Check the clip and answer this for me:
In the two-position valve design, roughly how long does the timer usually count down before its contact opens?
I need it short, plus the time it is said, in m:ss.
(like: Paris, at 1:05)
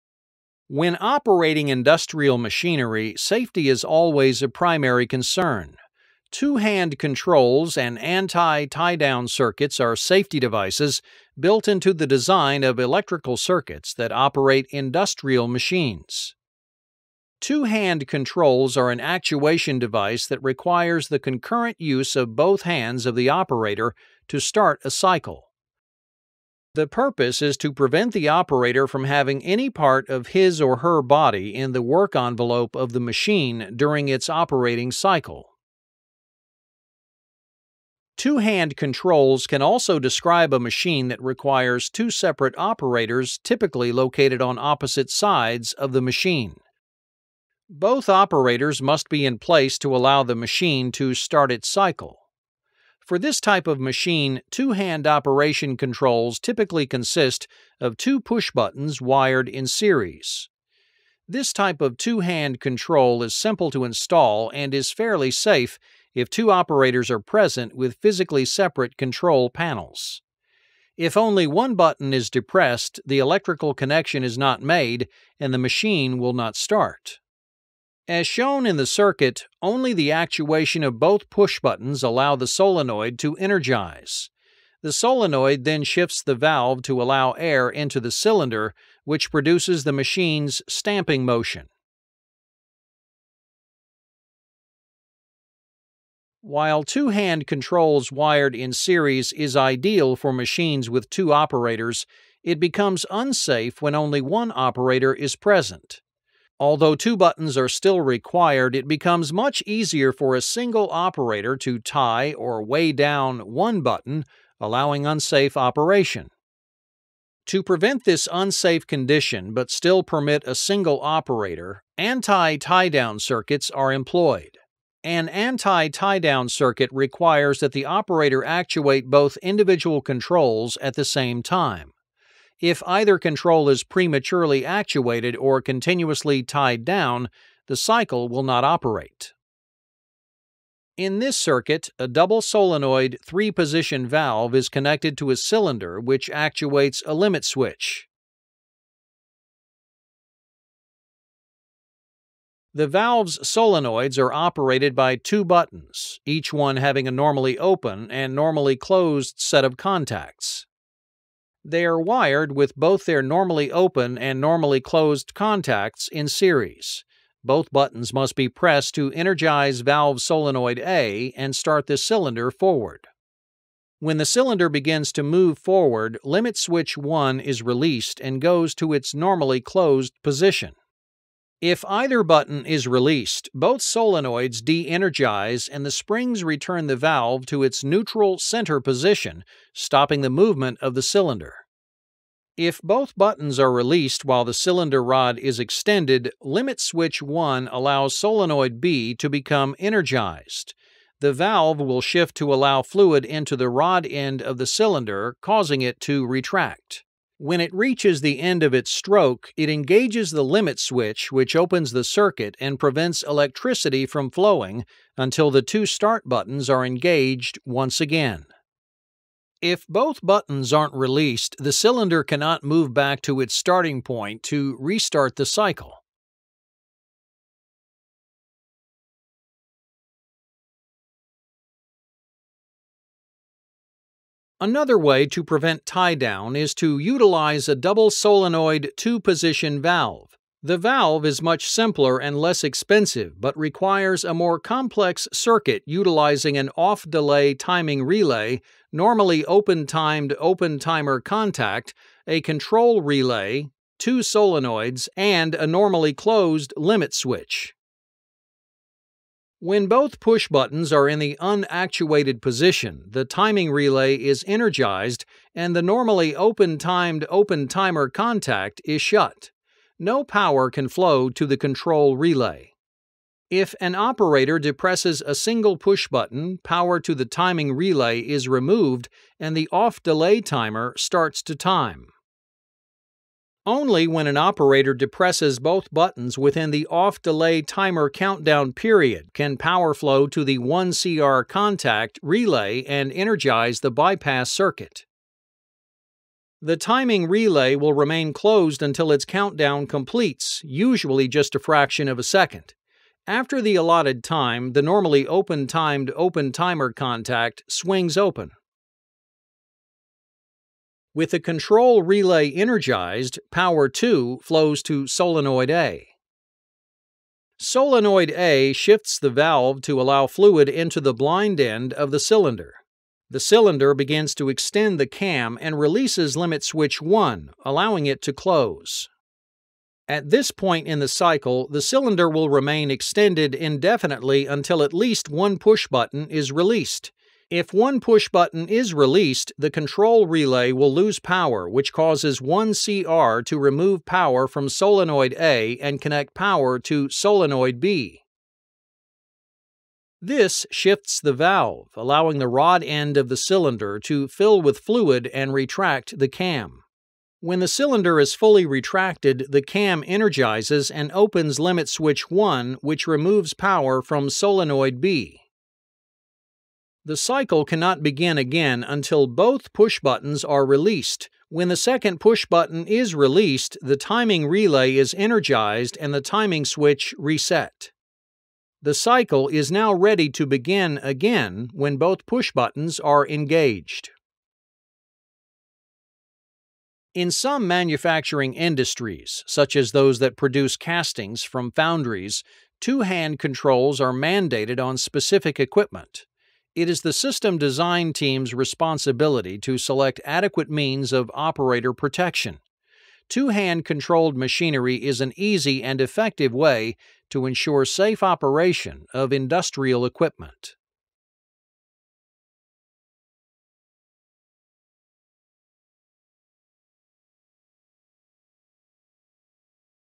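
A fraction of a second, at 5:01.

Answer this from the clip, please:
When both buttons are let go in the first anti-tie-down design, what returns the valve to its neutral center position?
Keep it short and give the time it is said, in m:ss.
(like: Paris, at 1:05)
The springs, at 3:05.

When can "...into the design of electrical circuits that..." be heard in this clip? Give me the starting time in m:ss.
0:11.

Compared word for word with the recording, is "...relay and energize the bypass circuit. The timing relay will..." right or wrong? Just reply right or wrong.
right.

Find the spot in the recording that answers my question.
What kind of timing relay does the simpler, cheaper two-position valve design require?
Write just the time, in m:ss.
4:06.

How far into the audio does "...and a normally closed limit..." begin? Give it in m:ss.
4:15.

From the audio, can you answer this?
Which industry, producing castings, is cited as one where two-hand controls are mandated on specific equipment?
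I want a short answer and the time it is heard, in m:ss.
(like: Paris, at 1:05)
Foundries, at 6:31.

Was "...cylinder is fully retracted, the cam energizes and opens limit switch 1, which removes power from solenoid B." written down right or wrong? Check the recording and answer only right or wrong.
right.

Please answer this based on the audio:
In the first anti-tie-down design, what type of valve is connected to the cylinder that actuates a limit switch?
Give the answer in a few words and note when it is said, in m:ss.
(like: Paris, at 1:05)
Double solenoid three position valve, at 2:22.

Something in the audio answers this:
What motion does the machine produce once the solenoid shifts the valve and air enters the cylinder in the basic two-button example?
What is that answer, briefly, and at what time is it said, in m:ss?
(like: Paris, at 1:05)
Stamping motion, at 1:30.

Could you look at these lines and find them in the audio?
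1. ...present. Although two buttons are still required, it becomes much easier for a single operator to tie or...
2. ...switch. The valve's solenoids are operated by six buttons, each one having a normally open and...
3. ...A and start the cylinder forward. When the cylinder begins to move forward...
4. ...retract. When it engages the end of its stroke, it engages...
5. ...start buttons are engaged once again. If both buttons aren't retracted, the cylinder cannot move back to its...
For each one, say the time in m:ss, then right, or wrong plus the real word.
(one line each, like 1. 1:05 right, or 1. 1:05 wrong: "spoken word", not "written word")
1. 1:45 right
2. 2:27 wrong: "two", not "six"
3. 2:50 right
4. 3:26 wrong: "reaches", not "engages"
5. 3:35 wrong: "released", not "retracted".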